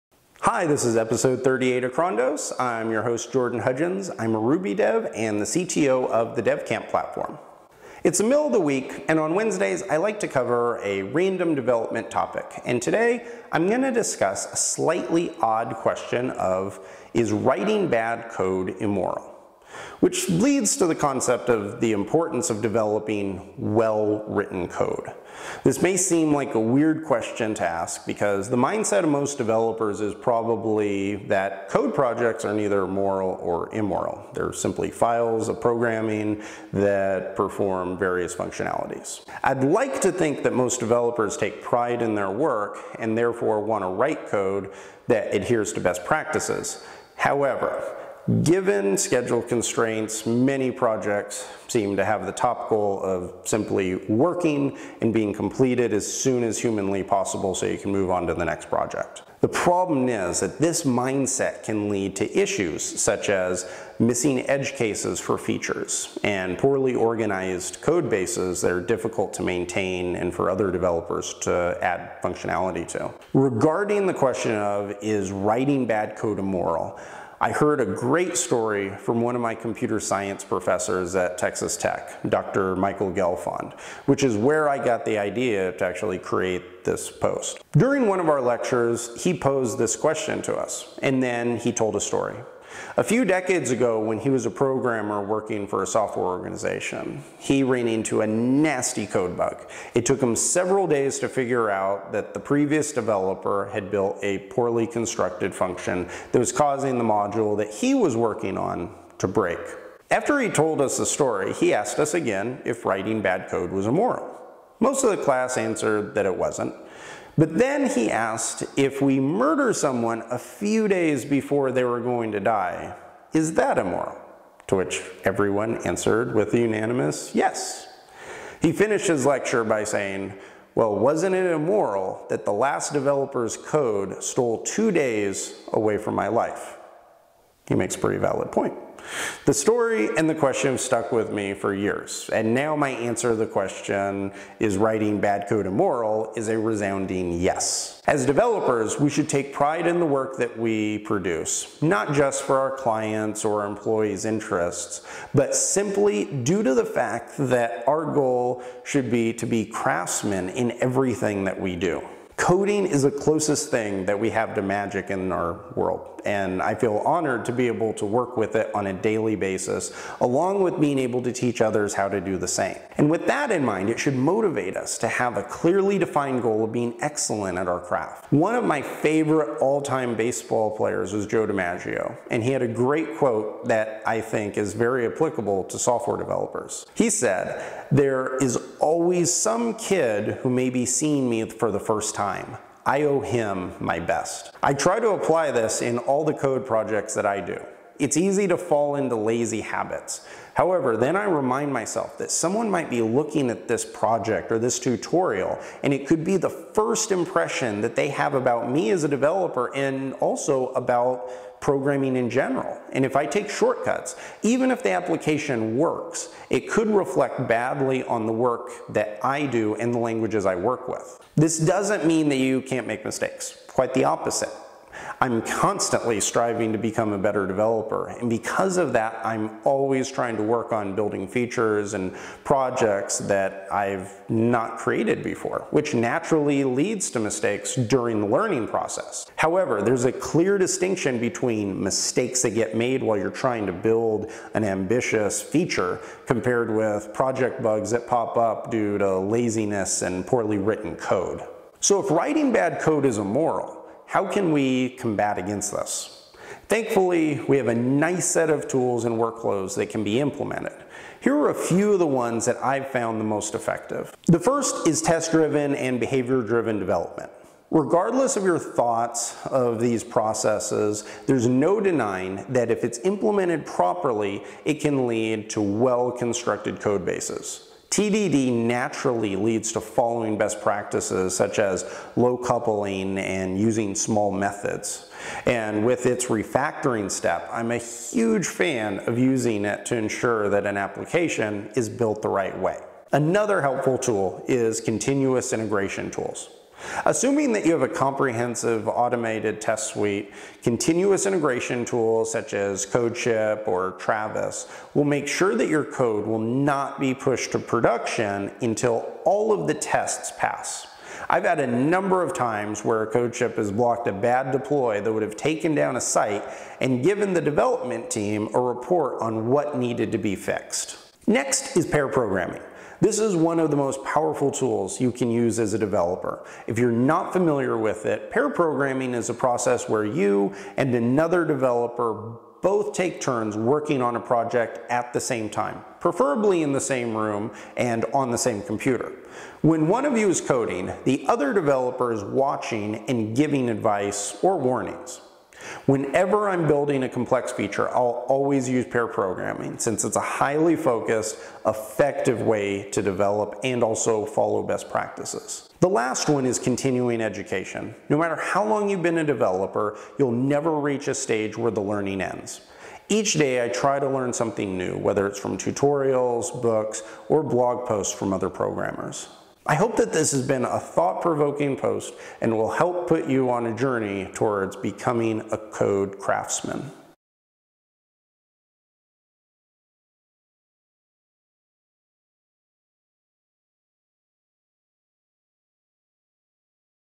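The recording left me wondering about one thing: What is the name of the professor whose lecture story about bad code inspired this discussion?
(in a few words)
Michael Gelfond.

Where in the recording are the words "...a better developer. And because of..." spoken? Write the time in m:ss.
3:47.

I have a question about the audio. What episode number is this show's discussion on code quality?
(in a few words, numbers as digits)
38.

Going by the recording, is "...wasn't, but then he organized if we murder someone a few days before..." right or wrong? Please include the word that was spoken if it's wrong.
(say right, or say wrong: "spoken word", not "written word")
wrong: "asked", not "organized".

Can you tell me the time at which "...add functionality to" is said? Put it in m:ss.
1:11.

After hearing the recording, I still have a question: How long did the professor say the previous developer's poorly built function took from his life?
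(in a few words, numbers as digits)
2 days.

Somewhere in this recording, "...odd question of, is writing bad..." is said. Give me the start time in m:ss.
0:15.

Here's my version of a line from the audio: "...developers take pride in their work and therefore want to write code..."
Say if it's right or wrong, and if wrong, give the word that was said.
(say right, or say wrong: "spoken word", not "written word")
right.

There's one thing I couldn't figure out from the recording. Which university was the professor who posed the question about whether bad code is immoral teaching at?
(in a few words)
Texas Tech.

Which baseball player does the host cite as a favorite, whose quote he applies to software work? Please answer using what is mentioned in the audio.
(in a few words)
Joe DiMaggio.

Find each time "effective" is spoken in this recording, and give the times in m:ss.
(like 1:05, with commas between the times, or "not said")
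4:23, 5:51.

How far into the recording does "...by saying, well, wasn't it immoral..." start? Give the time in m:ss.
2:09.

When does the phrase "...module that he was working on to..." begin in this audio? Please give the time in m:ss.
1:47.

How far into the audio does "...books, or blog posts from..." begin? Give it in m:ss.
6:06.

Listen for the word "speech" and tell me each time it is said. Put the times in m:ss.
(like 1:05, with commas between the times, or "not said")
not said.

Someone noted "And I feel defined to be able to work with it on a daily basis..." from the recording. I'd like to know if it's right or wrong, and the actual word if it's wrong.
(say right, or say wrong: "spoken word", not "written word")
wrong: "honored", not "defined".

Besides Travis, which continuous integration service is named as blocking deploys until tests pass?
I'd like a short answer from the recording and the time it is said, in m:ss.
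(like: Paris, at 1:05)
CodeShip, at 5:02.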